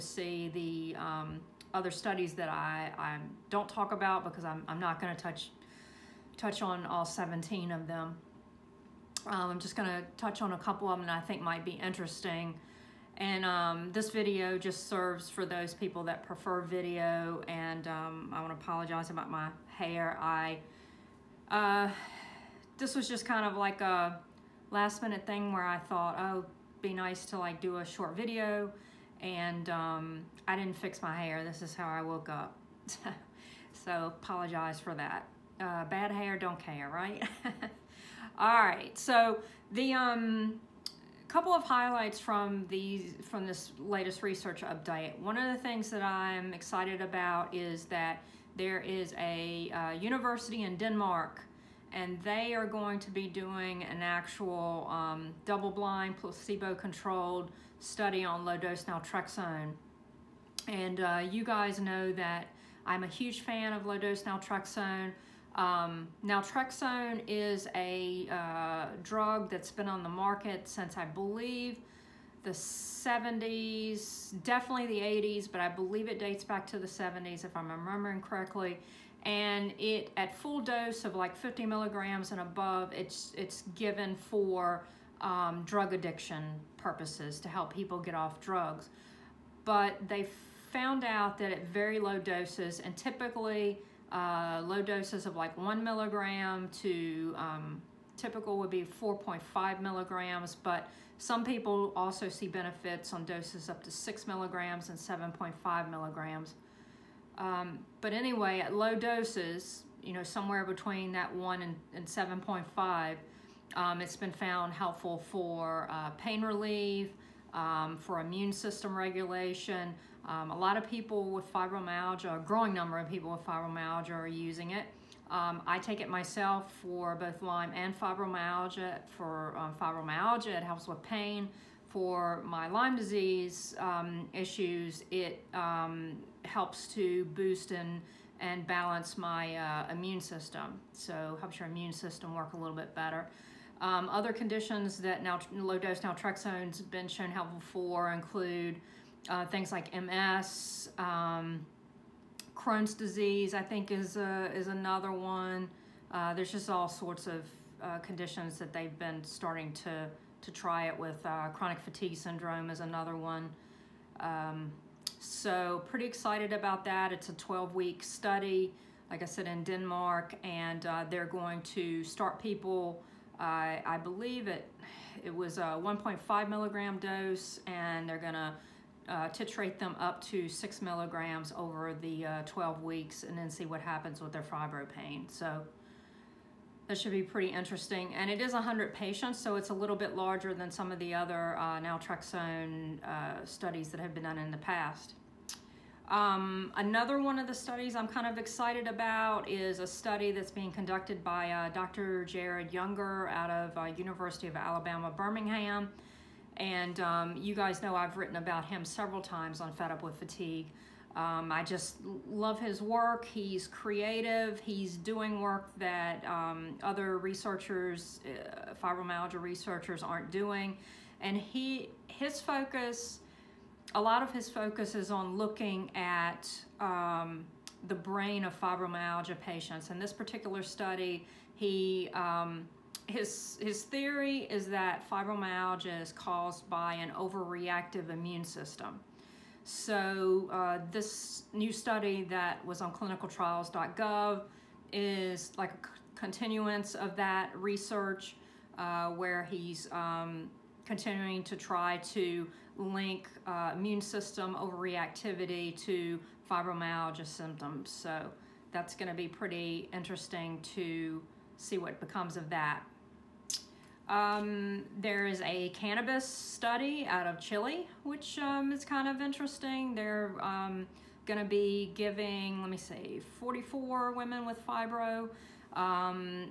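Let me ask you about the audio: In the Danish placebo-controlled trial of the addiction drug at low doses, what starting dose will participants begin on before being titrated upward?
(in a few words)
1.5 milligrams.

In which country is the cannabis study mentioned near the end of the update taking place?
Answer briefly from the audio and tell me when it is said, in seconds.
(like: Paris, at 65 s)
Chile, at 267 s.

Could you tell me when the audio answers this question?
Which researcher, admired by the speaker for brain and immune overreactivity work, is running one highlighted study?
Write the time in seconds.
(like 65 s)
202 s.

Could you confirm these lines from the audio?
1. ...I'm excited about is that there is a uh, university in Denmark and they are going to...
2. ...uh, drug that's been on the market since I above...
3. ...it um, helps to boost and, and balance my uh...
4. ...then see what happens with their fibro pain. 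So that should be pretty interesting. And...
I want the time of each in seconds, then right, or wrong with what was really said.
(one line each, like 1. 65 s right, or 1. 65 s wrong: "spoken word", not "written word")
1. 46 s right
2. 68 s wrong: "believe", not "above"
3. 135 s right
4. 183 s right.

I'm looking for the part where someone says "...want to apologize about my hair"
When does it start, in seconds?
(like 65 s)
18 s.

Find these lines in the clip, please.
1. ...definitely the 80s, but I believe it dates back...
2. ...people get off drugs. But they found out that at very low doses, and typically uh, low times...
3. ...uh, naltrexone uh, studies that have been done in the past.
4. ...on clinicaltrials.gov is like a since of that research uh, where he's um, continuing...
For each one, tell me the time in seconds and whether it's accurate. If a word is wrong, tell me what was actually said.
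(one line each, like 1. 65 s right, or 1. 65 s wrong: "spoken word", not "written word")
1. 74 s right
2. 87 s wrong: "doses", not "times"
3. 191 s right
4. 242 s wrong: "continuance", not "since".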